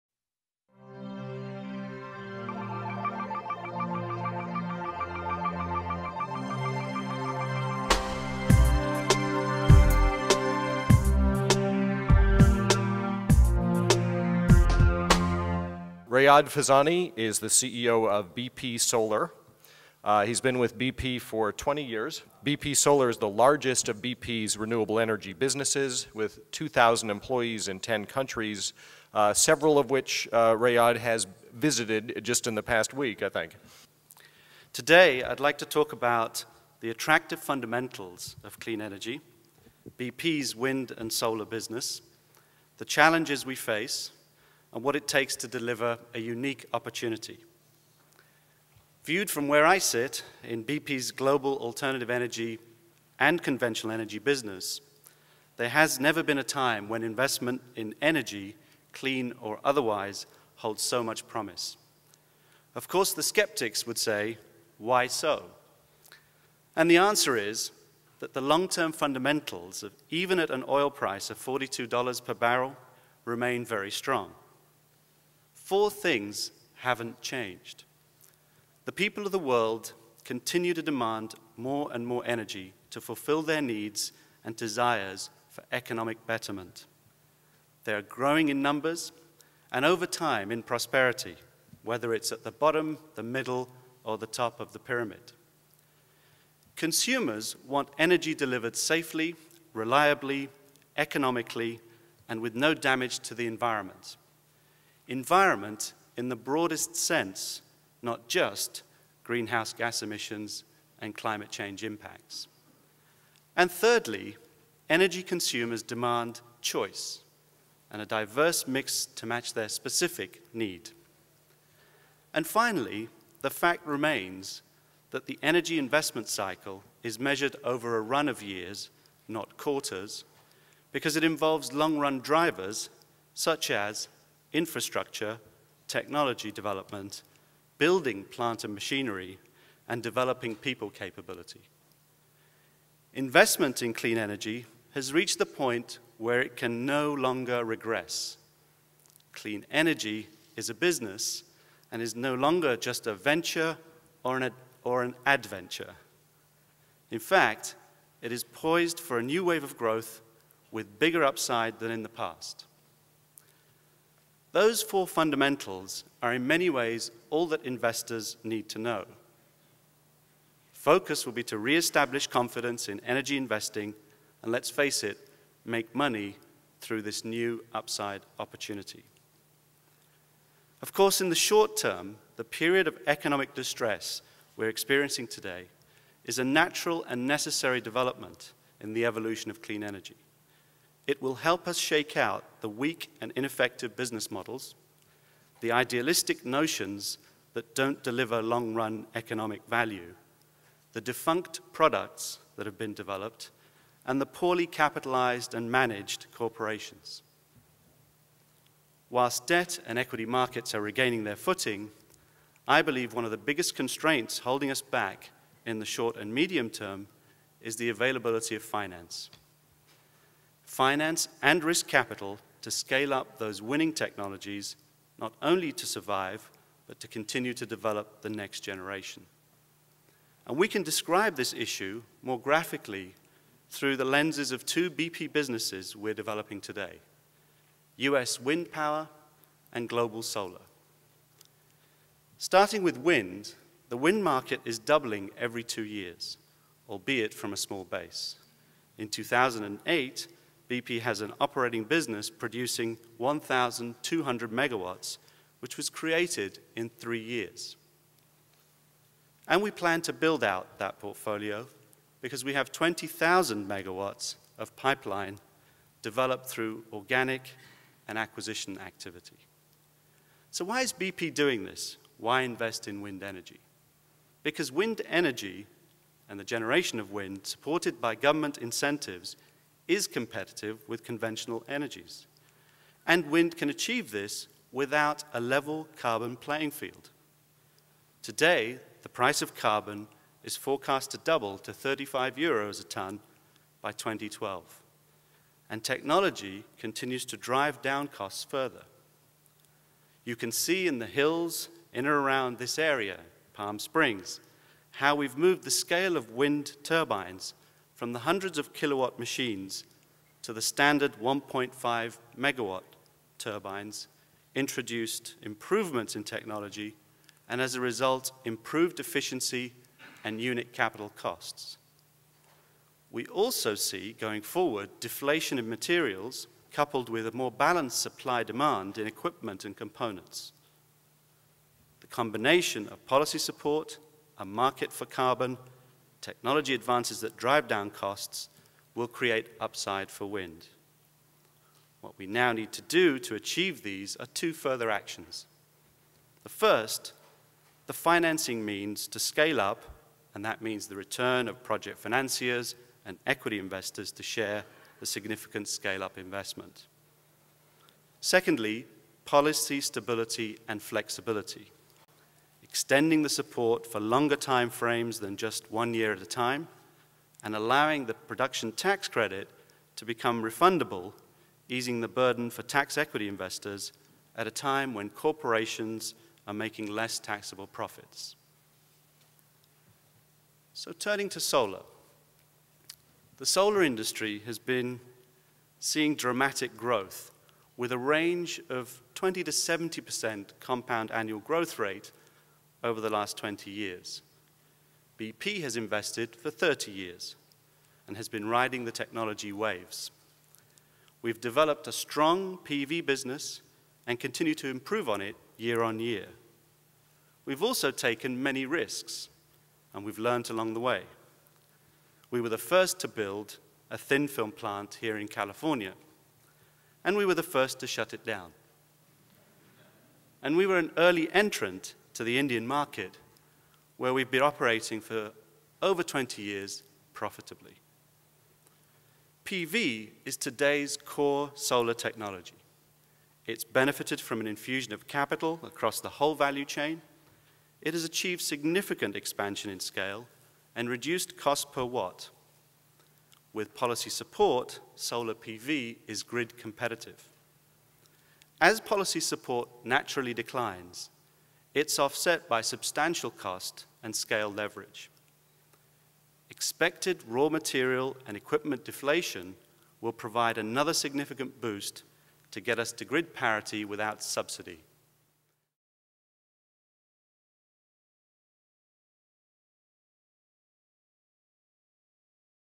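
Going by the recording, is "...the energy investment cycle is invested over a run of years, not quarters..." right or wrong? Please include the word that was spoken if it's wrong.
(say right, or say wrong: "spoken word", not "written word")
wrong: "measured", not "invested".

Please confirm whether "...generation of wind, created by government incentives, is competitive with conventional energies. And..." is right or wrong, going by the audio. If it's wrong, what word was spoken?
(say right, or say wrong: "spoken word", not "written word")
wrong: "supported", not "created".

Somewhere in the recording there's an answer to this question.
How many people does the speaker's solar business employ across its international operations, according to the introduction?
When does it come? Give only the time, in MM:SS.
00:26.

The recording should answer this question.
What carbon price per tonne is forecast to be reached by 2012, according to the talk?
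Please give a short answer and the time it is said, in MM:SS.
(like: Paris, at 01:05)
35 euros, at 04:51.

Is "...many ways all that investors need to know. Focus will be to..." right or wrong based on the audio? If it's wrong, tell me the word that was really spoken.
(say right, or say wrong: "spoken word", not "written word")
right.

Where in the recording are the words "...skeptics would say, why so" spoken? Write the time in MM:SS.
01:03.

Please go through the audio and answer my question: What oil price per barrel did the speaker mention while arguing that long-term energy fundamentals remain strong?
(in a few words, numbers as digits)
$42.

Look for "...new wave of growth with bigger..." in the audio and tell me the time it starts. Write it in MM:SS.
02:39.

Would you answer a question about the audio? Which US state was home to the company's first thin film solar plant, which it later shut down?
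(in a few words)
California.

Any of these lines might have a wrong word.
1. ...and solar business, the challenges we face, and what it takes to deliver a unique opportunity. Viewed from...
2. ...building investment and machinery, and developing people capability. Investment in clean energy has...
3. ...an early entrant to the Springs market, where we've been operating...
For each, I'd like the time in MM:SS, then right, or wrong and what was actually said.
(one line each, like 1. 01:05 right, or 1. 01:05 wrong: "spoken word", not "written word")
1. 00:40 right
2. 02:17 wrong: "plant", not "investment"
3. 07:00 wrong: "Indian", not "Springs".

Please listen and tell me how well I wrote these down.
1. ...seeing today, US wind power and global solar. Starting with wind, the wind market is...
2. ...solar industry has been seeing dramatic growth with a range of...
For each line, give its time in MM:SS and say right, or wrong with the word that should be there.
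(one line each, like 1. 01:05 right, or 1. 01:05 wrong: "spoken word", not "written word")
1. 03:56 wrong: "developing", not "seeing"
2. 06:23 right.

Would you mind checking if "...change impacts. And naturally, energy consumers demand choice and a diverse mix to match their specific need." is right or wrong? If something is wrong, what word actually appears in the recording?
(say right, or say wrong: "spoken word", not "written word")
wrong: "thirdly", not "naturally".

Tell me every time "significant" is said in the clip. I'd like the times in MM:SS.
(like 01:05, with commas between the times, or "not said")
05:55, 07:18, 07:40.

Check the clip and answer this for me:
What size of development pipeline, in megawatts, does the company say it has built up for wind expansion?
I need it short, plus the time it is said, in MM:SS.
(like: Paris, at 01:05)
20,000 megawatts, at 04:22.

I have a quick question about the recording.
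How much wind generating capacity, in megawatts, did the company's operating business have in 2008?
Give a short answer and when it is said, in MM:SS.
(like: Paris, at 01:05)
1,200 megawatts, at 04:13.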